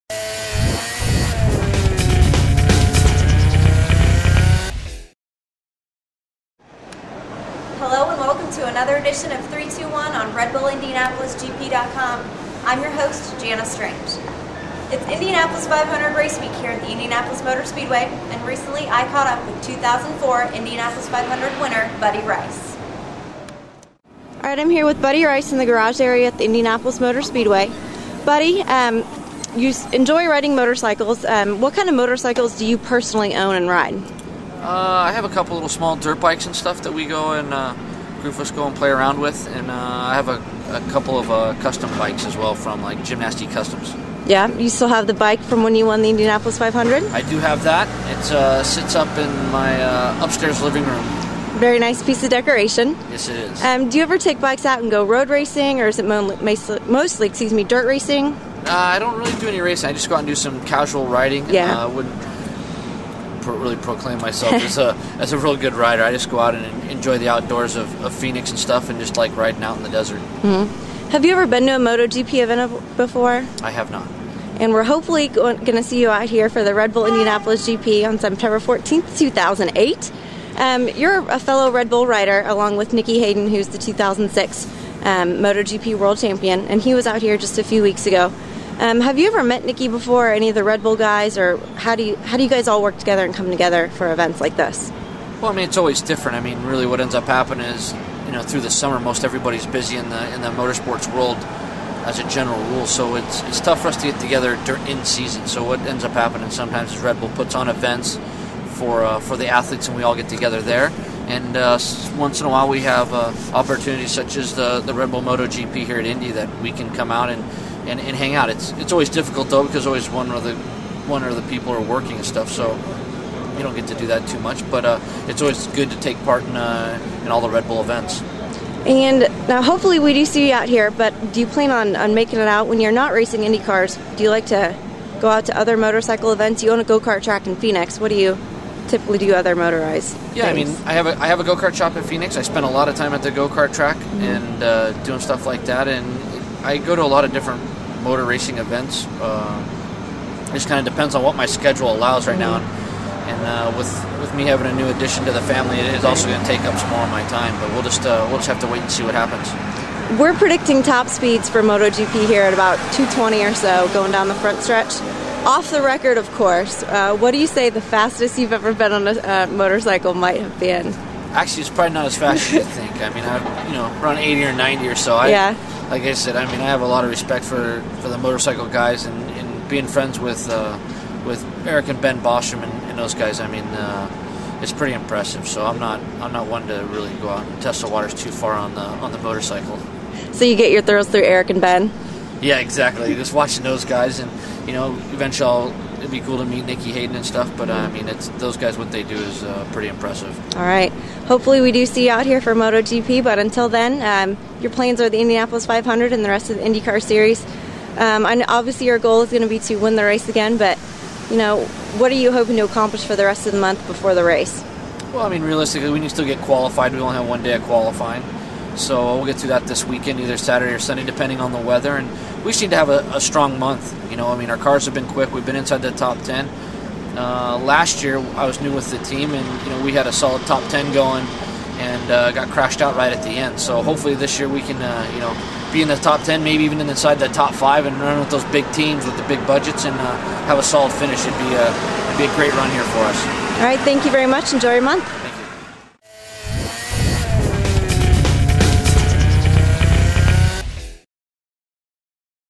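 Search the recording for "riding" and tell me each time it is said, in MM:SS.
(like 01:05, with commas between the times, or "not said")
00:30, 01:01, 01:09.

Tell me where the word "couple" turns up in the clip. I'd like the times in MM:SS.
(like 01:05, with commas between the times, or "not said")
00:35, 00:40.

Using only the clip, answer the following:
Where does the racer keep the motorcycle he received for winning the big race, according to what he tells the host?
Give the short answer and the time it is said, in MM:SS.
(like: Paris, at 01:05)
Upstairs living room, at 00:50.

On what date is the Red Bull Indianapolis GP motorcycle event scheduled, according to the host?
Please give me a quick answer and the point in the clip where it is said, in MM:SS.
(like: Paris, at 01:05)
September 14th, 2008, at 01:18.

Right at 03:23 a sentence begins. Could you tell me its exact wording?
But until then, um, your plans are the Indianapolis 500 and the rest of the IndyCar series.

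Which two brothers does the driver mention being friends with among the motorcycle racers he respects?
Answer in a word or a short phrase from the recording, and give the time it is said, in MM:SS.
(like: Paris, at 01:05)
Eric and Ben Bostrom, at 03:01.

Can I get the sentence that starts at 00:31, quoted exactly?
Um, what kind of motorcycles do you personally own and ride?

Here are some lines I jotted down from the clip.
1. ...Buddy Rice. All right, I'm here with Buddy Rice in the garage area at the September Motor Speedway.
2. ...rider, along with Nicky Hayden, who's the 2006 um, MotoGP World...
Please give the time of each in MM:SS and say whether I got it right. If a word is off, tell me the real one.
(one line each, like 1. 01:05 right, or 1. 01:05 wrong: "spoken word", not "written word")
1. 00:21 wrong: "Indianapolis", not "September"
2. 01:22 right.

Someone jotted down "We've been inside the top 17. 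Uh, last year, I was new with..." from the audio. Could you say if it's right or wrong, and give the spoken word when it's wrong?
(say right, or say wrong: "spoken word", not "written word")
wrong: "10", not "17".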